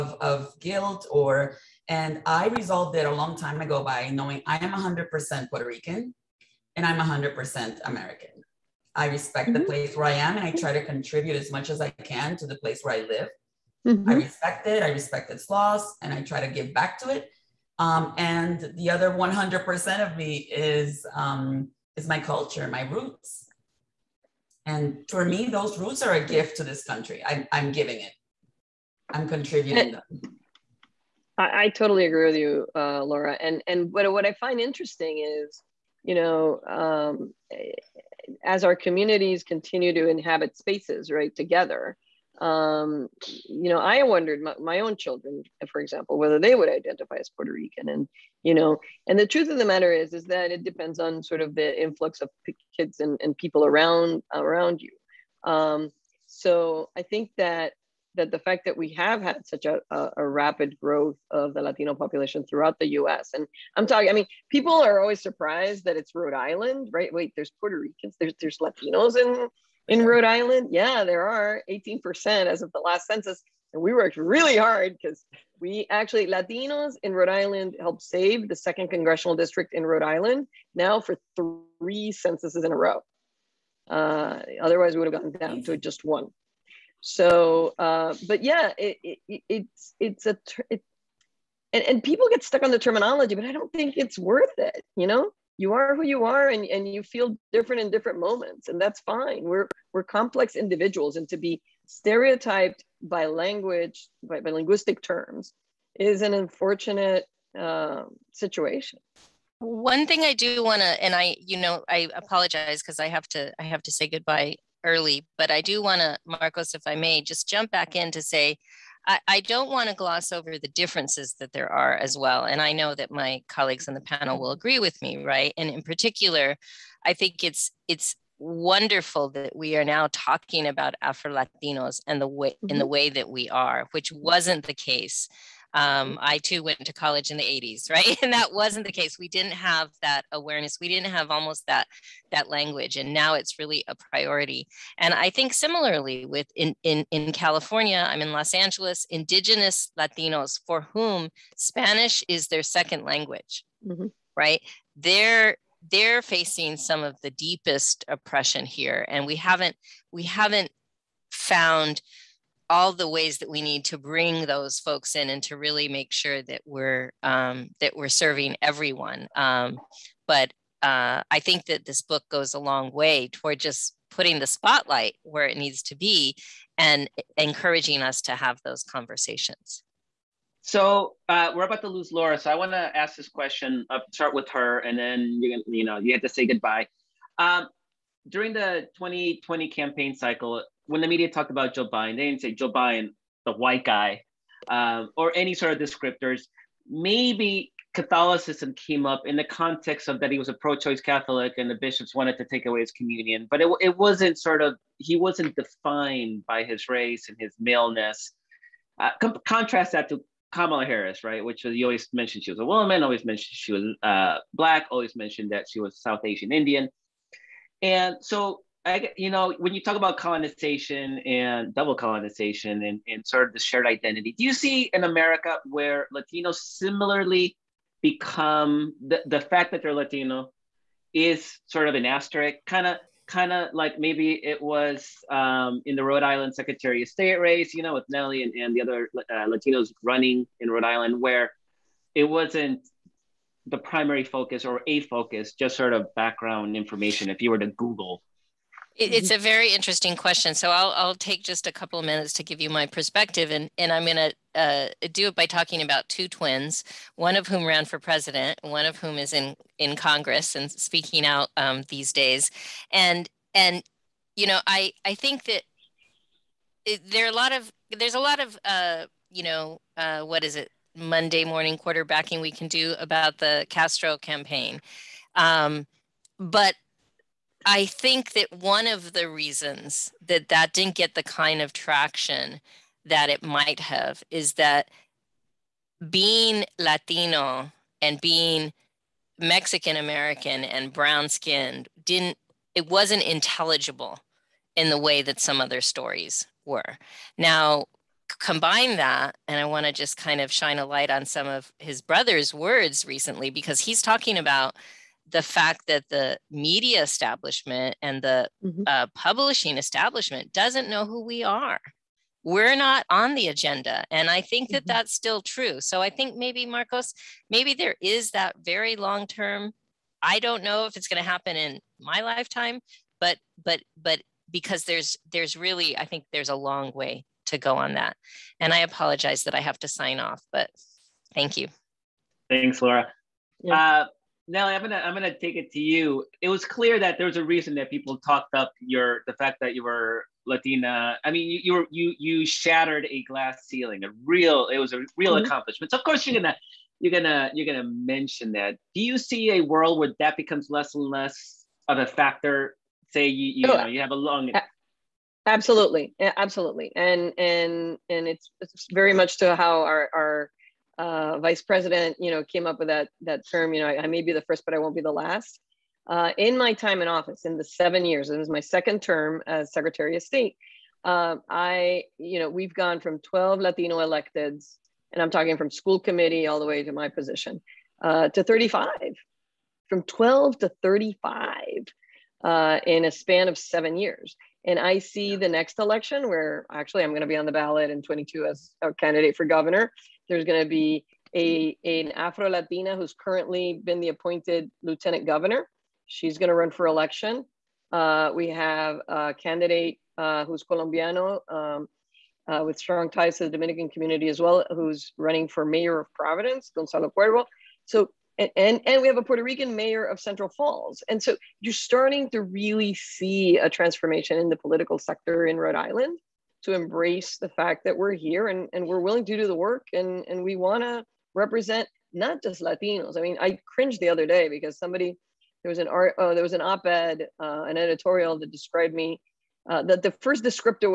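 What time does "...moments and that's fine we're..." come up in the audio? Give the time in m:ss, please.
1:38.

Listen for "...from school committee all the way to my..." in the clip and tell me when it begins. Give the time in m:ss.
6:15.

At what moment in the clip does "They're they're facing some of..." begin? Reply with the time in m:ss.
2:34.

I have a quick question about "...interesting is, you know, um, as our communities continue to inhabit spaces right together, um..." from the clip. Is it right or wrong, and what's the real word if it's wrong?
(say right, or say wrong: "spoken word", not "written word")
right.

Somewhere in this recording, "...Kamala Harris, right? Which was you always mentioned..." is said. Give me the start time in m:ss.
3:30.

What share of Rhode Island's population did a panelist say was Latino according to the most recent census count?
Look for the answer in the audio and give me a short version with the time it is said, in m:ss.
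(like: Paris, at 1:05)
18%, at 1:11.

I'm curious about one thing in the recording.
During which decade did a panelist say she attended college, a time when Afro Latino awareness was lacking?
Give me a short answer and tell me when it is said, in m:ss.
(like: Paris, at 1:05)
1980s, at 2:17.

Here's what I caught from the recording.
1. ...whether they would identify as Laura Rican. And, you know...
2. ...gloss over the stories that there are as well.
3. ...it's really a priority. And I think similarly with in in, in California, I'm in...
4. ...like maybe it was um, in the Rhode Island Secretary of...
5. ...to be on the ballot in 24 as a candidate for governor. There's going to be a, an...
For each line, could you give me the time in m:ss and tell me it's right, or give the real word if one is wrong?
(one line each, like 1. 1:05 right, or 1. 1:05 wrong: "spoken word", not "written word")
1. 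0:46 wrong: "Puerto", not "Laura"
2. 1:59 wrong: "differences", not "stories"
3. 2:23 right
4. 3:53 right
5. 6:27 wrong: "22", not "24".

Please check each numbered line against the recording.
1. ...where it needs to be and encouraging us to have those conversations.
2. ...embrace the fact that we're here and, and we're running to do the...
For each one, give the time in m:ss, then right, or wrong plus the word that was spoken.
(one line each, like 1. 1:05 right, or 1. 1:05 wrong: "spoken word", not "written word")
1. 2:55 right
2. 6:56 wrong: "willing", not "running".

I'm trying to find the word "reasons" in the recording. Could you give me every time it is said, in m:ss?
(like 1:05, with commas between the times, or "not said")
4:39, 5:37.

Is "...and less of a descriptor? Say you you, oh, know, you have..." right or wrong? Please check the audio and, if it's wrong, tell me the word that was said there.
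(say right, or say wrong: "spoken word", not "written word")
wrong: "factor", not "descriptor".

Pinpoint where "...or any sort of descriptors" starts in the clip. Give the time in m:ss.
3:15.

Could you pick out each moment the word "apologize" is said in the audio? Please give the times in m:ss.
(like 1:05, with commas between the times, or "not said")
1:52, 5:28.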